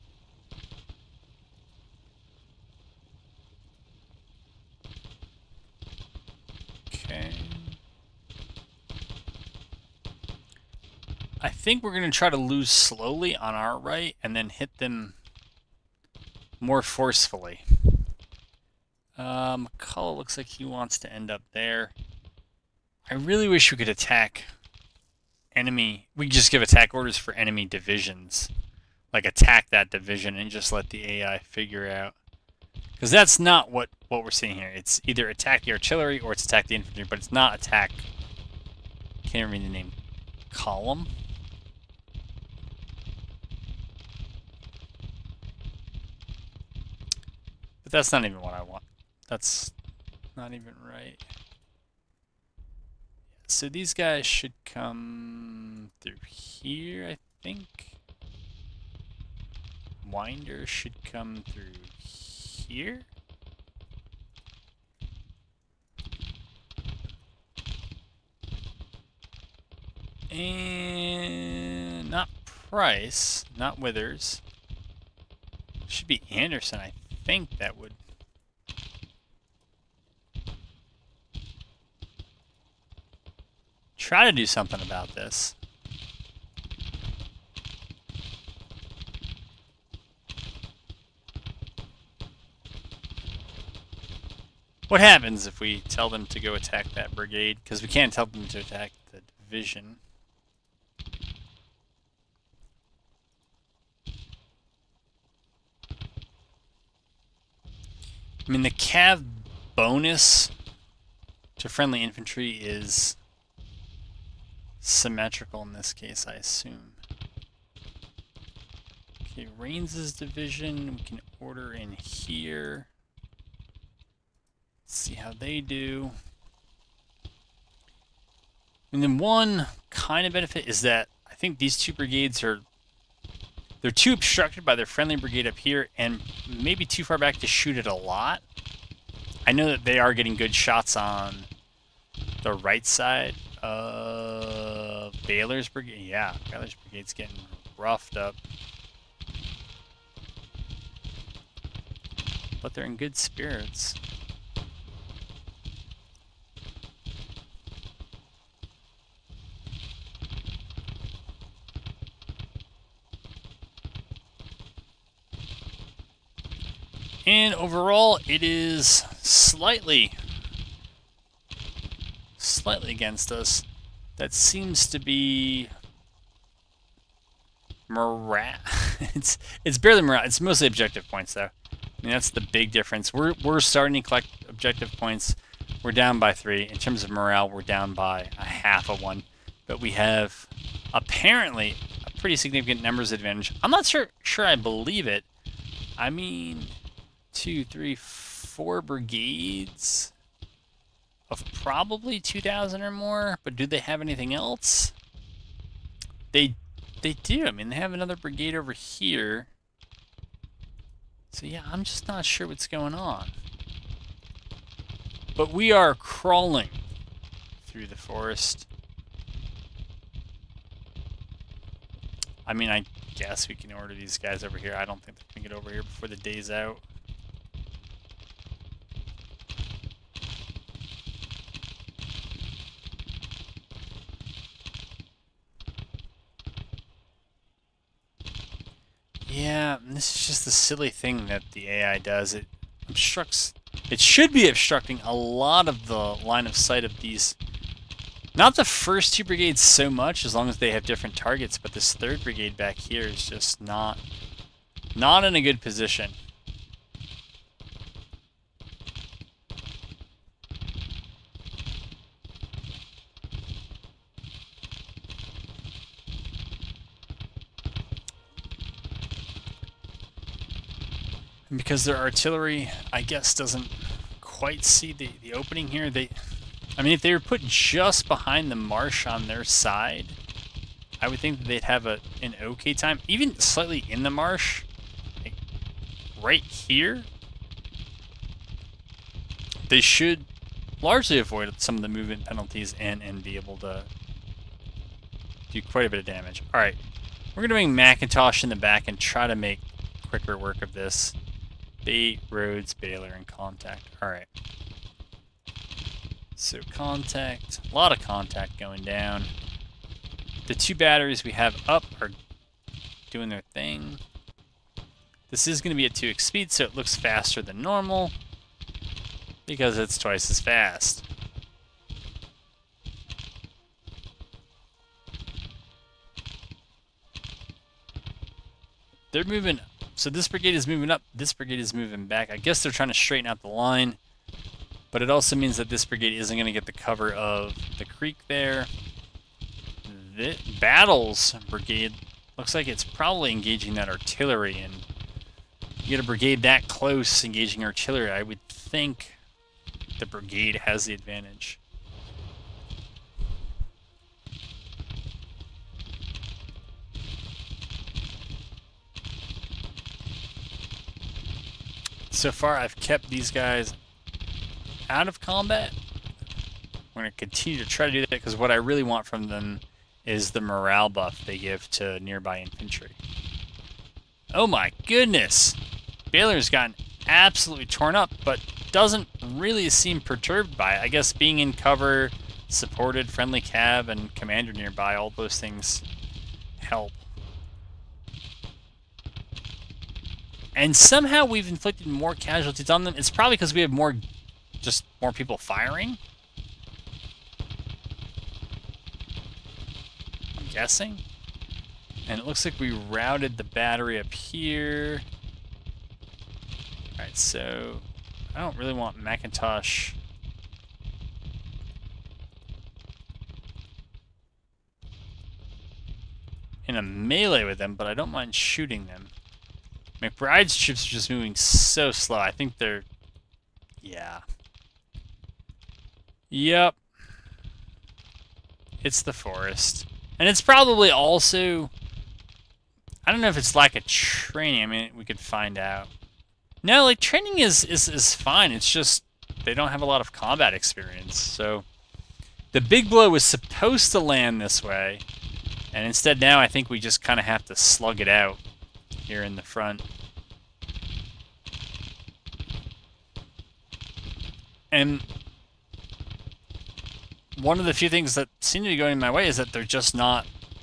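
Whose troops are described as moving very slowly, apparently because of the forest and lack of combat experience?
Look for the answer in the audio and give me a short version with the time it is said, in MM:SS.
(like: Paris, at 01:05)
McBride's, at 07:00.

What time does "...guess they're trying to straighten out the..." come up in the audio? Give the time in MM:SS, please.
05:32.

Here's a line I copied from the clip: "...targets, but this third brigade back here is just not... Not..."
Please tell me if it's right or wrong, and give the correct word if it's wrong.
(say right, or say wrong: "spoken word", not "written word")
right.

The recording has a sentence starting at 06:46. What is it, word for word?
Alright, so I don't really want McIntosh.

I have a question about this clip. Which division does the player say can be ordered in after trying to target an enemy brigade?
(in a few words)
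Rains' division.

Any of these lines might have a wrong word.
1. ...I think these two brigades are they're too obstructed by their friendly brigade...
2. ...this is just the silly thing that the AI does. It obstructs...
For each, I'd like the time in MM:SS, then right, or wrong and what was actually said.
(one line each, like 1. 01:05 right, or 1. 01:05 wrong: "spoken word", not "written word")
1. 02:11 right
2. 03:59 right.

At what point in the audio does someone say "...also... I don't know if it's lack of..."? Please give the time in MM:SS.
07:10.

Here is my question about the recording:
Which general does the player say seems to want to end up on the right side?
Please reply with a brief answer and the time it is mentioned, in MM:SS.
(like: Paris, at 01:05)
McCulloch, at 00:19.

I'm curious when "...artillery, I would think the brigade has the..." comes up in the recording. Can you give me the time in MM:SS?
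05:47.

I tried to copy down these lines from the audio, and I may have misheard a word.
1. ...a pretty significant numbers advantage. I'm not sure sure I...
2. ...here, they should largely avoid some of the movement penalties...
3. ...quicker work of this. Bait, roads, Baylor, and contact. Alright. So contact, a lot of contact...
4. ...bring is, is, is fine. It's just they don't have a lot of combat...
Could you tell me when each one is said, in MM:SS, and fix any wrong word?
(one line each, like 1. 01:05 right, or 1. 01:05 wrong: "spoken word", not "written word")
1. 03:12 right
2. 04:46 right
3. 05:00 right
4. 07:16 wrong: "training", not "bring".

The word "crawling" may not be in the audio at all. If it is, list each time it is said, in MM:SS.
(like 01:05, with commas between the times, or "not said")
03:35.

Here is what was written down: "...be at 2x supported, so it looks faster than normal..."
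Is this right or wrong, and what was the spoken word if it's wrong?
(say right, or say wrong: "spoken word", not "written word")
wrong: "speed", not "supported".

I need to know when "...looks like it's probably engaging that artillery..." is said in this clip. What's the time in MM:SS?
05:42.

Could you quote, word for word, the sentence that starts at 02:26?
Yeah, Baylor's brigade's getting roughed up.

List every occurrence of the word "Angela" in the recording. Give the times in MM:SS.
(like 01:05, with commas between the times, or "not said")
not said.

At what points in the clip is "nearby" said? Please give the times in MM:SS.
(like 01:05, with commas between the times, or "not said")
06:12, 06:24.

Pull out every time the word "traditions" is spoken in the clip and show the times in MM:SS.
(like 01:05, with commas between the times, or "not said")
not said.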